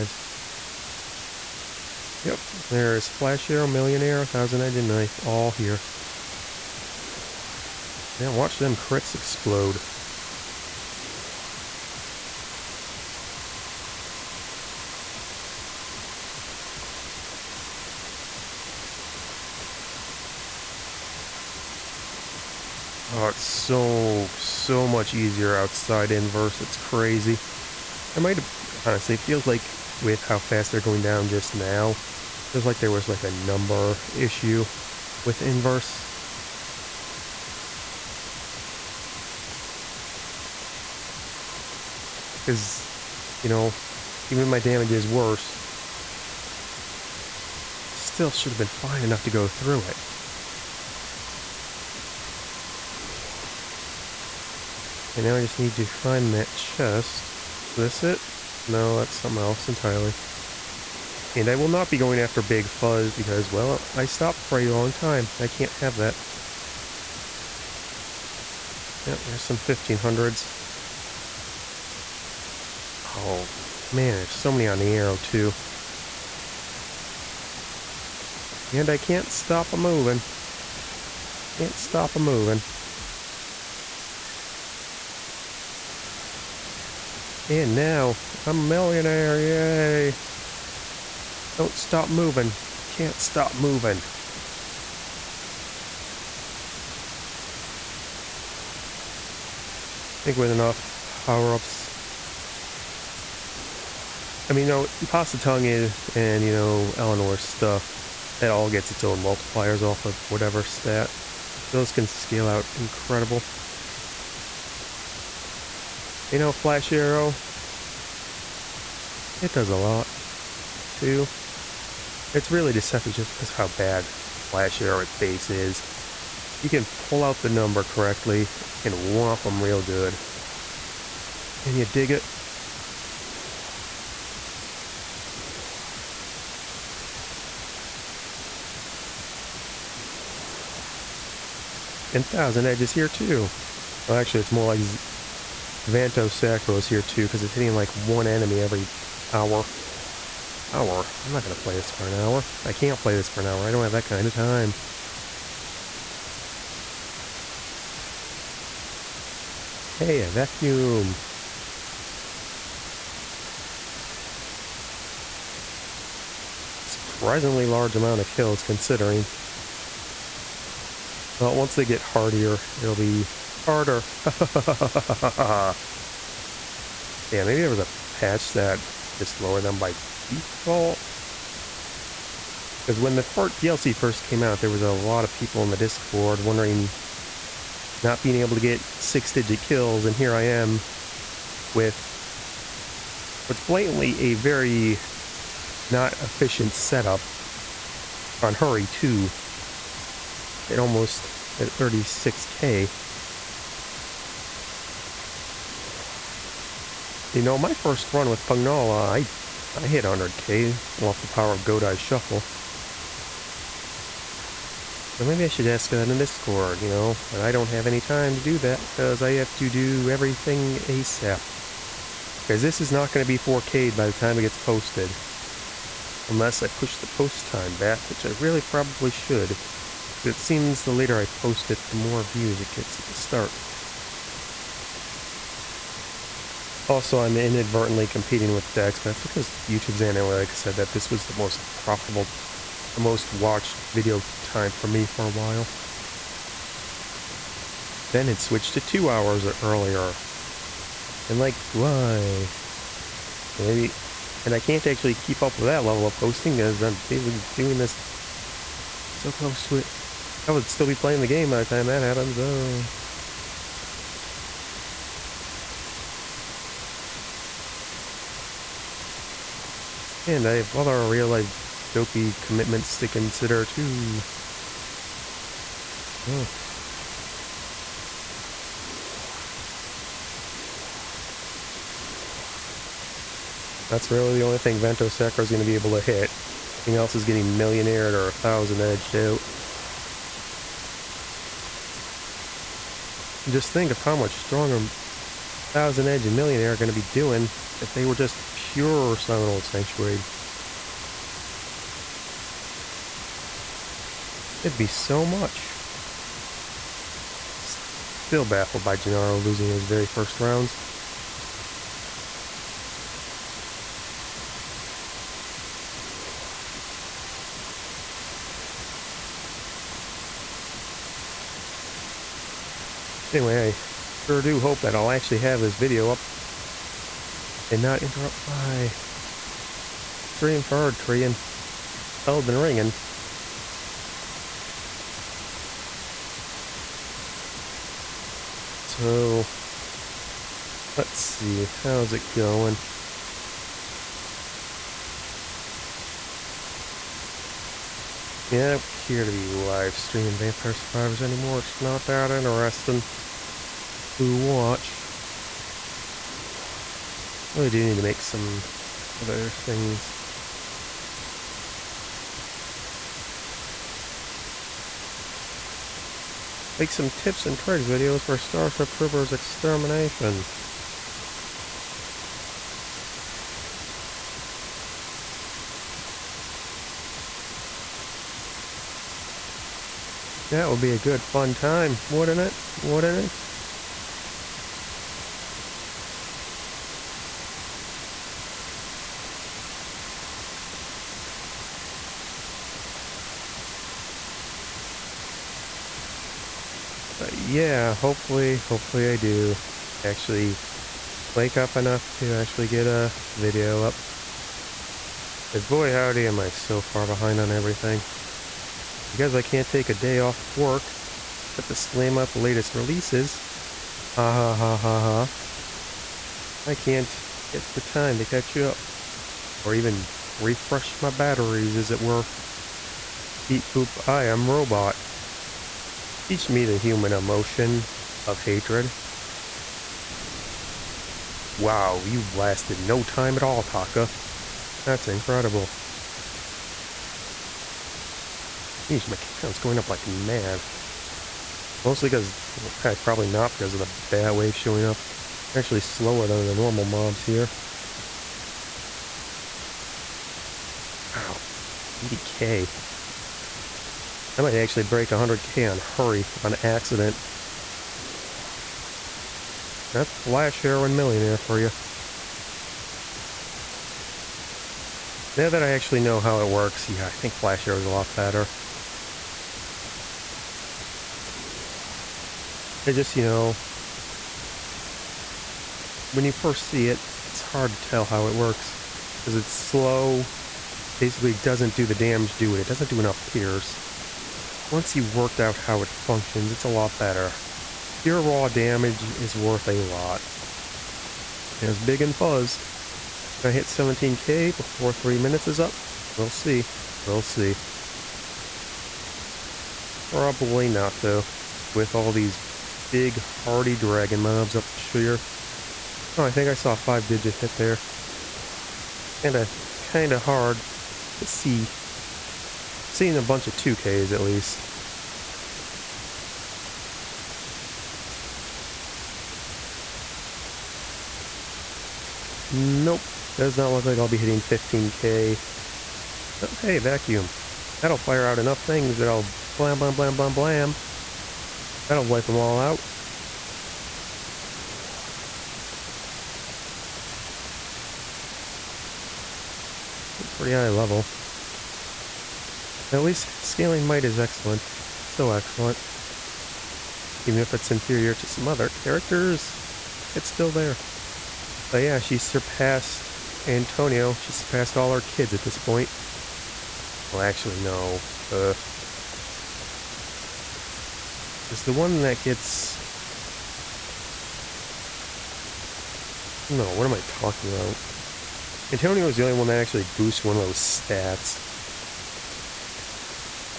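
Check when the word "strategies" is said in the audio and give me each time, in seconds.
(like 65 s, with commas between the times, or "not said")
not said.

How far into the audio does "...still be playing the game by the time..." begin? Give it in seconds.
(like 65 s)
260 s.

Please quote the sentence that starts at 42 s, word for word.
Because, you know, even if my damage is worse, still should have been fine enough to go through it.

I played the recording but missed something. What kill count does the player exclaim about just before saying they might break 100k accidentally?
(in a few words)
80k.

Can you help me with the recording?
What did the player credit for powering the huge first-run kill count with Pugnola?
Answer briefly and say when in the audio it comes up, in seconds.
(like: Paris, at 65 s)
Godai Shuffle, at 211 s.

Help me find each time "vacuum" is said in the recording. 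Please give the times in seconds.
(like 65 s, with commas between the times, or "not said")
160 s, 526 s.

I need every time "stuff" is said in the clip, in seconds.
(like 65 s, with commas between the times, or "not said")
107 s.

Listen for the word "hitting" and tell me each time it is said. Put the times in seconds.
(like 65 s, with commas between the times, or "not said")
147 s, 524 s.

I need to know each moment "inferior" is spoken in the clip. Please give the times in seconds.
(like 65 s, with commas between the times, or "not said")
547 s.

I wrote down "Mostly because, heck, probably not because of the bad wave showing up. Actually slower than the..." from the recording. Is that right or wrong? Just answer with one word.
right.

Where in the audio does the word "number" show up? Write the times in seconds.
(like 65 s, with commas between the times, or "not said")
33 s, 127 s.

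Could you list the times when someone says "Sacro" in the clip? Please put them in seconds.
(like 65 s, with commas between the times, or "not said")
146 s, 285 s.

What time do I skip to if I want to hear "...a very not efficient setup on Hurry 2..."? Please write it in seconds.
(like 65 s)
194 s.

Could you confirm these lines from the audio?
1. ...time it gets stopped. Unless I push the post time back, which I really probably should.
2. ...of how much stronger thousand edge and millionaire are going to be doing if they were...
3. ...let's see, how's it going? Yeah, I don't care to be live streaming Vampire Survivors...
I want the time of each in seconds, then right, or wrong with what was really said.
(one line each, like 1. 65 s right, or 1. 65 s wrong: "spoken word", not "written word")
1. 224 s wrong: "posted", not "stopped"
2. 293 s right
3. 340 s right.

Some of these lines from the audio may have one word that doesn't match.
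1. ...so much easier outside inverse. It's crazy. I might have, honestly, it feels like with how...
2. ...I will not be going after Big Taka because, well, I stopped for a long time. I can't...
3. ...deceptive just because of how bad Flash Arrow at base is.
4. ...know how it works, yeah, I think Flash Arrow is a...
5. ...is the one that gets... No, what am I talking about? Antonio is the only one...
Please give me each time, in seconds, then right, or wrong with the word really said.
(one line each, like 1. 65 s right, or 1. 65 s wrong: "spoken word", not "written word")
1. 24 s right
2. 61 s wrong: "Fuzz", not "Taka"
3. 122 s right
4. 466 s right
5. 561 s right.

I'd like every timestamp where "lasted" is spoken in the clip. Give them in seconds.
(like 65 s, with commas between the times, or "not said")
432 s.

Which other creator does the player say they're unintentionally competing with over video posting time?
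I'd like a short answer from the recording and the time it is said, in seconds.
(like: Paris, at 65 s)
Dex, at 238 s.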